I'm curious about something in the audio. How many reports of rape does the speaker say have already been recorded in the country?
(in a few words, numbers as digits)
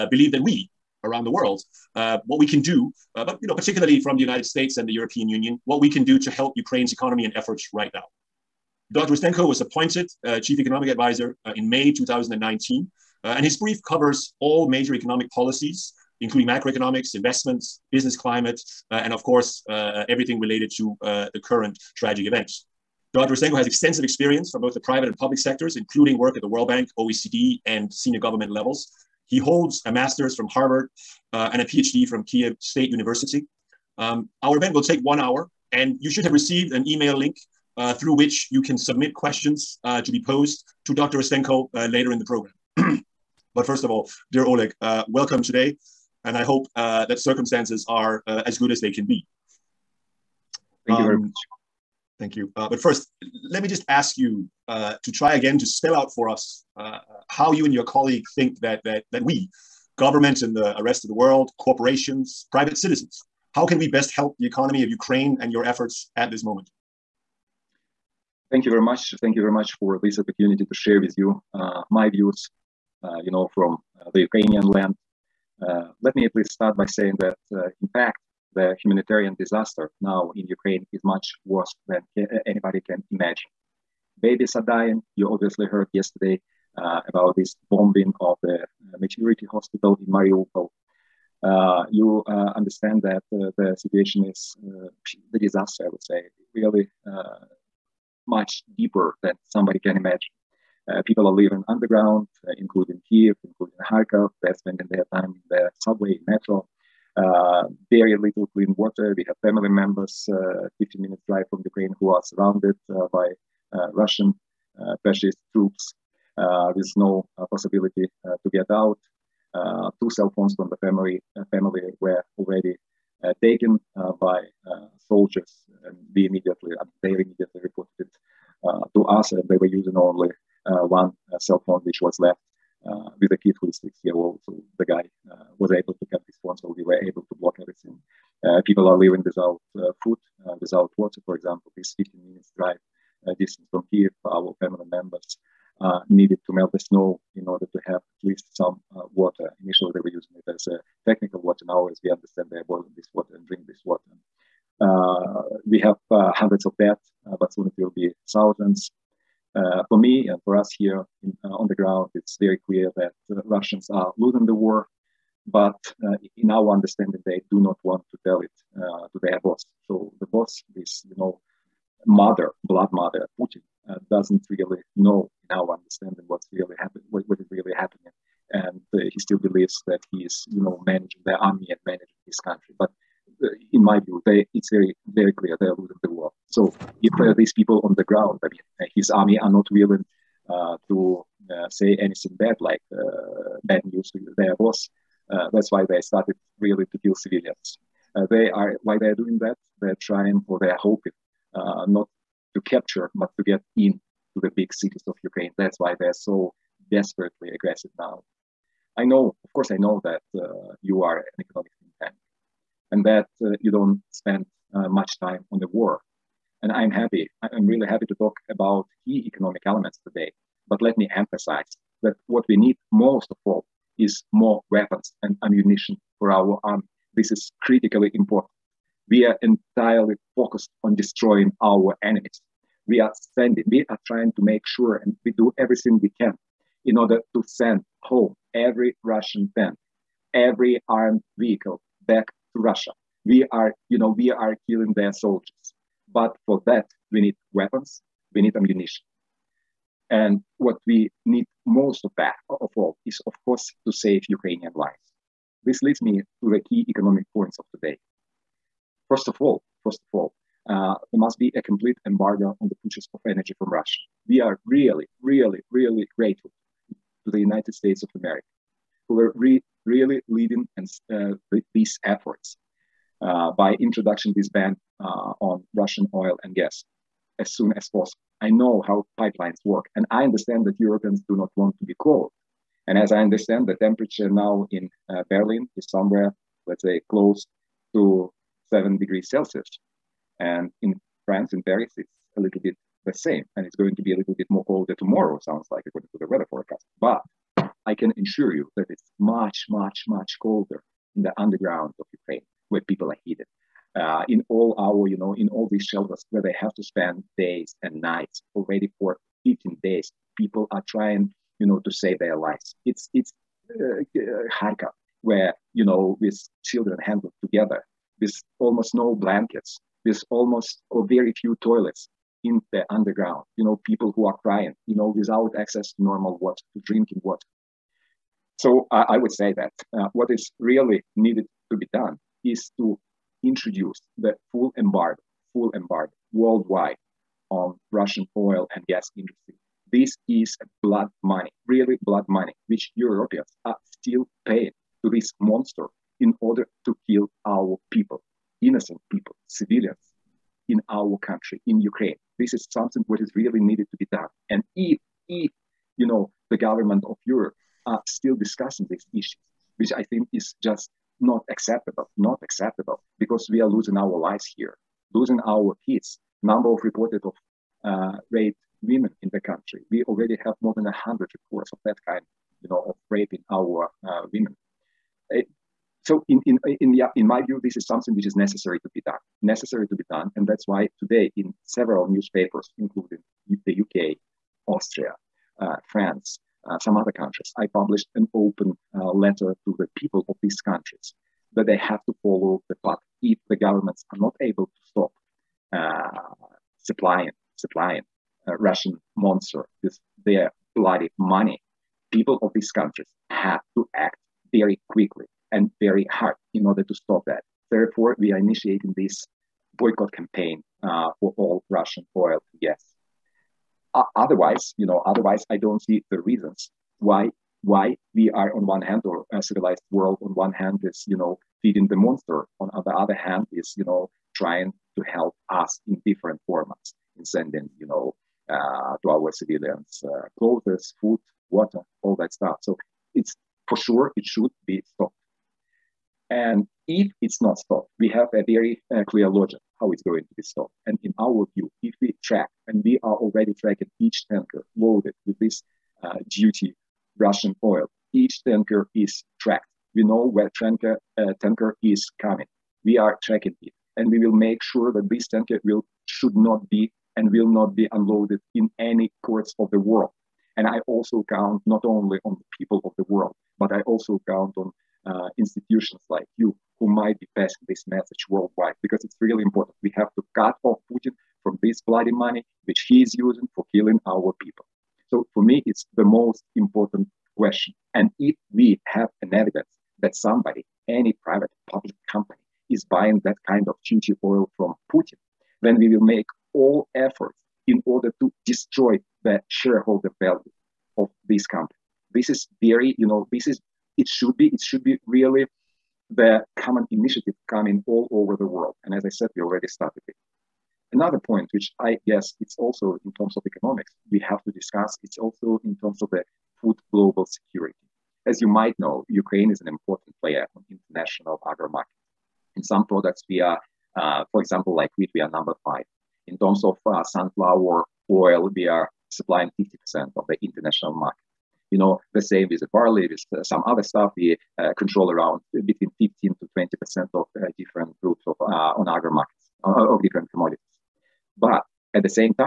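More than 100.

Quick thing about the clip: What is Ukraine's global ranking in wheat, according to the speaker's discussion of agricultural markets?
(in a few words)
5.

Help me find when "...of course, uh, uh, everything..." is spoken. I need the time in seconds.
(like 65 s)
19 s.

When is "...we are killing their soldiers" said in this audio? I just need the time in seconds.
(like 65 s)
244 s.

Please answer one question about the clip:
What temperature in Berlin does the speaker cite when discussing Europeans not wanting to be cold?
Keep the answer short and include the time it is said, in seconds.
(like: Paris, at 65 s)
7 degrees Celsius, at 288 s.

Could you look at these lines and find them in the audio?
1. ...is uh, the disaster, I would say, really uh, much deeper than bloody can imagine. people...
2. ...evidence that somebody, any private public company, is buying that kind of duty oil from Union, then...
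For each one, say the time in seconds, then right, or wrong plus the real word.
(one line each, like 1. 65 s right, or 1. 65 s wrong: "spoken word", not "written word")
1. 94 s wrong: "somebody", not "bloody"
2. 479 s wrong: "Putin", not "Union".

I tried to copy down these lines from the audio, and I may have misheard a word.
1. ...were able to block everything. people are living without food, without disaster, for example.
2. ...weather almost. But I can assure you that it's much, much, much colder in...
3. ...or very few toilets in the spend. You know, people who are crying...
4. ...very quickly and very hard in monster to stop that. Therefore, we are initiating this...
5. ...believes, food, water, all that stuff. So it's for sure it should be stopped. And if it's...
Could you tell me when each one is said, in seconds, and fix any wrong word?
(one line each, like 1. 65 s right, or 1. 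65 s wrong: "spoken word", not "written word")
1. 136 s wrong: "water", not "disaster"
2. 296 s wrong: "forecast", not "almost"
3. 320 s wrong: "underground", not "spend"
4. 404 s wrong: "order", not "monster"
5. 430 s wrong: "clothes", not "believes".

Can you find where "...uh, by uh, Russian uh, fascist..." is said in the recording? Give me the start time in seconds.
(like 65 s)
112 s.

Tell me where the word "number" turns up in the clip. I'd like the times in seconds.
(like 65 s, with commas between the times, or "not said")
366 s, 515 s.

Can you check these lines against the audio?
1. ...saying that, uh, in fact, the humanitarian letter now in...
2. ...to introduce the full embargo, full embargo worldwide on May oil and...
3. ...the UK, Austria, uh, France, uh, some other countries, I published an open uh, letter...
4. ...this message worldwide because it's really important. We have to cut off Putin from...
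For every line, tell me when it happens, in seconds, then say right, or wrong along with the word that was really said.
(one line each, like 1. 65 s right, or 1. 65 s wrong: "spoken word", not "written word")
1. 76 s wrong: "disaster", not "letter"
2. 332 s wrong: "Russian", not "May"
3. 383 s right
4. 467 s right.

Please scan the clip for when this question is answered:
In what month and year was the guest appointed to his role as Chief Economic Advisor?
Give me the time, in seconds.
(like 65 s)
11 s.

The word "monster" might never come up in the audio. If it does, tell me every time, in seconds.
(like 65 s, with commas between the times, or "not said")
345 s, 399 s, 421 s.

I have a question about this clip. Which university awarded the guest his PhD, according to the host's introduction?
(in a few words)
Kiev State University.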